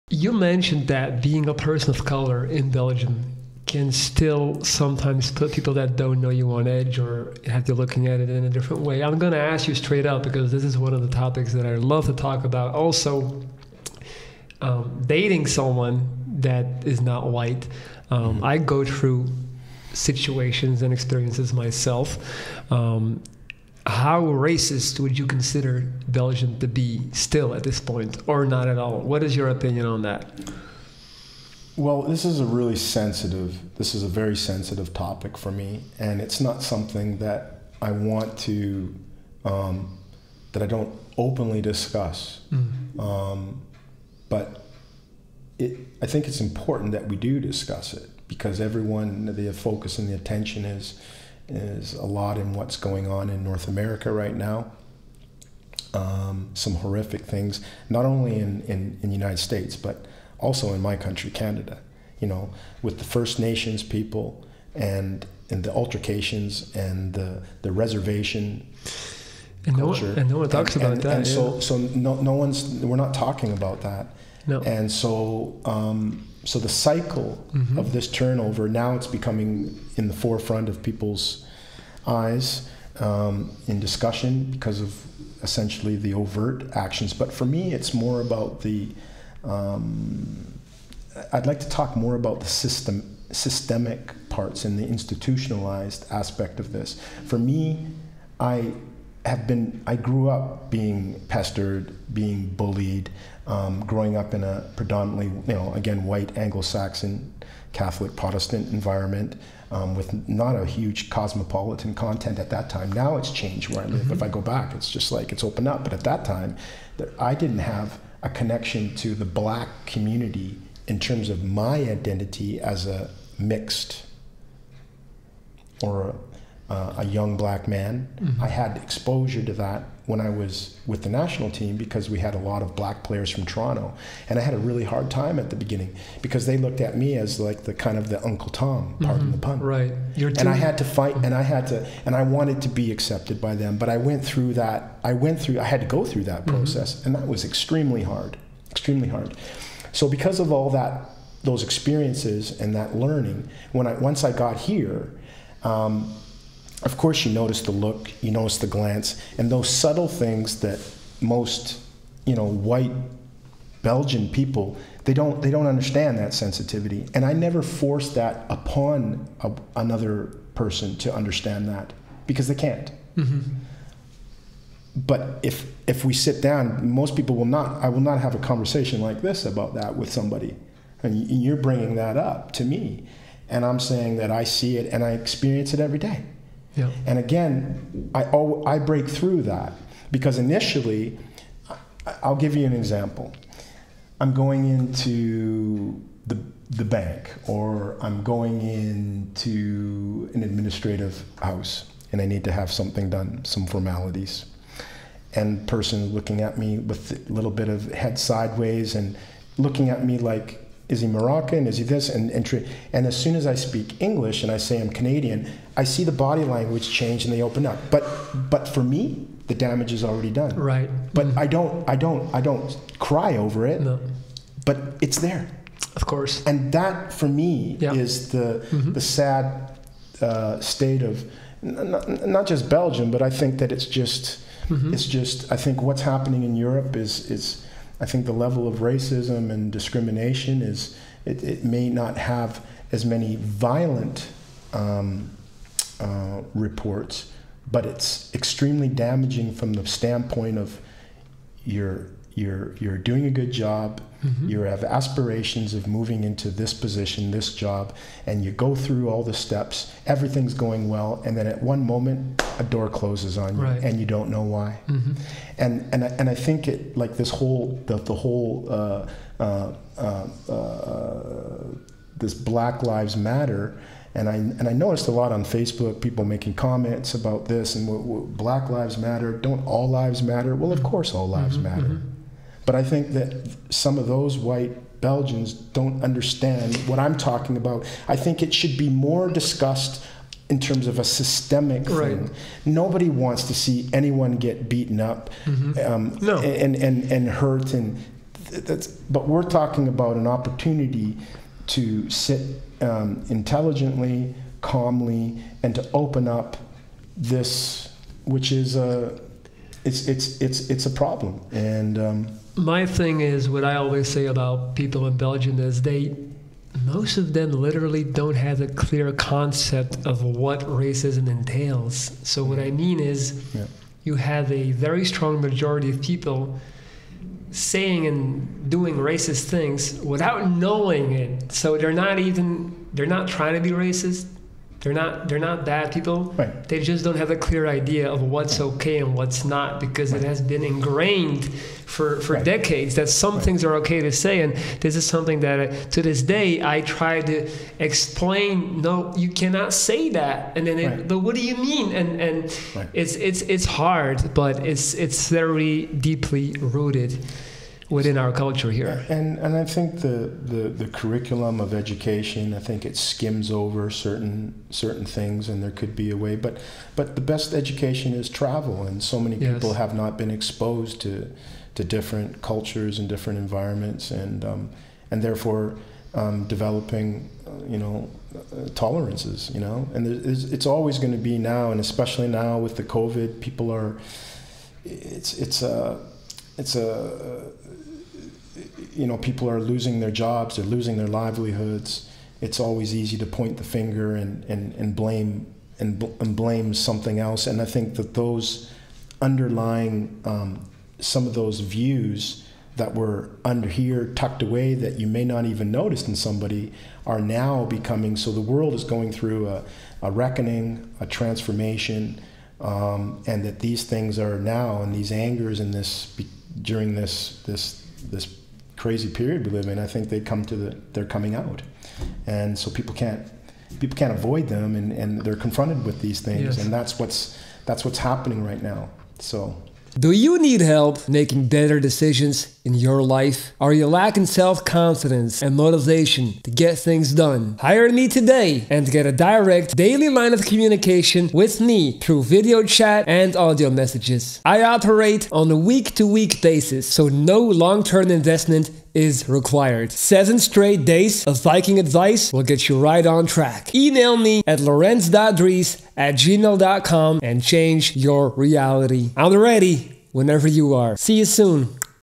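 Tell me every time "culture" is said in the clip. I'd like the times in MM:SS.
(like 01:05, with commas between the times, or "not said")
01:09, 05:58, 06:12.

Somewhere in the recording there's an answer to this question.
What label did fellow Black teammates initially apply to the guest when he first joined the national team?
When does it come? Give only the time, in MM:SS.
02:18.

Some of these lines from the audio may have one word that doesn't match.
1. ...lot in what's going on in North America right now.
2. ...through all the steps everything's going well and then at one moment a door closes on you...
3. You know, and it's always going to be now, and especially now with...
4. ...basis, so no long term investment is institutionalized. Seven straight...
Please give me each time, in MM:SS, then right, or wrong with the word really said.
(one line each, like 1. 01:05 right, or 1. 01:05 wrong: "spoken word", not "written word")
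1. 00:52 right
2. 04:18 right
3. 06:19 right
4. 07:26 wrong: "required", not "institutionalized".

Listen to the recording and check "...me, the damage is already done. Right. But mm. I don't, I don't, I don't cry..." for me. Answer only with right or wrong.
right.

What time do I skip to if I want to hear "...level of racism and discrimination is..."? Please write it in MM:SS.
03:58.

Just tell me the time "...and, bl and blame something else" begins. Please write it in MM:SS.
06:35.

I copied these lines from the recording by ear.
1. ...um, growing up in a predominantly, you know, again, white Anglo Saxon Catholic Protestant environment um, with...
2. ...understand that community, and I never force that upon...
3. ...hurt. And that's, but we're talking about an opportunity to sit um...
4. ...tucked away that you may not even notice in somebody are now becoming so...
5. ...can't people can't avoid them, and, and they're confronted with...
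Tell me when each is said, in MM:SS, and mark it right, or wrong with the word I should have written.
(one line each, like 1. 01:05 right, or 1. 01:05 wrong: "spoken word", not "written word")
1. 01:43 right
2. 02:45 wrong: "sensitivity", not "community"
3. 04:57 right
4. 06:44 right
5. 07:02 right.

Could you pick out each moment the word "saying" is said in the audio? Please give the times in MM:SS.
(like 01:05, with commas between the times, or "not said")
03:03, 05:27.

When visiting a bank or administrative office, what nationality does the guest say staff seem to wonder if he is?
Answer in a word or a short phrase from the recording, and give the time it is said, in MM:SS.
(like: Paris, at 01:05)
Moroccan, at 03:31.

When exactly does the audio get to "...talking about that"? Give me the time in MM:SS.
01:13.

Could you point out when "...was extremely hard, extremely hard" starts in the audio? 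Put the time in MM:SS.
02:27.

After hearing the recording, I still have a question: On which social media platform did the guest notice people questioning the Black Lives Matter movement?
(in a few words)
Facebook.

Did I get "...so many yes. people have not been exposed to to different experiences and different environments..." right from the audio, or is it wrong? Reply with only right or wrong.
wrong.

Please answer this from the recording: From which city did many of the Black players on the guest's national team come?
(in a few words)
Toronto.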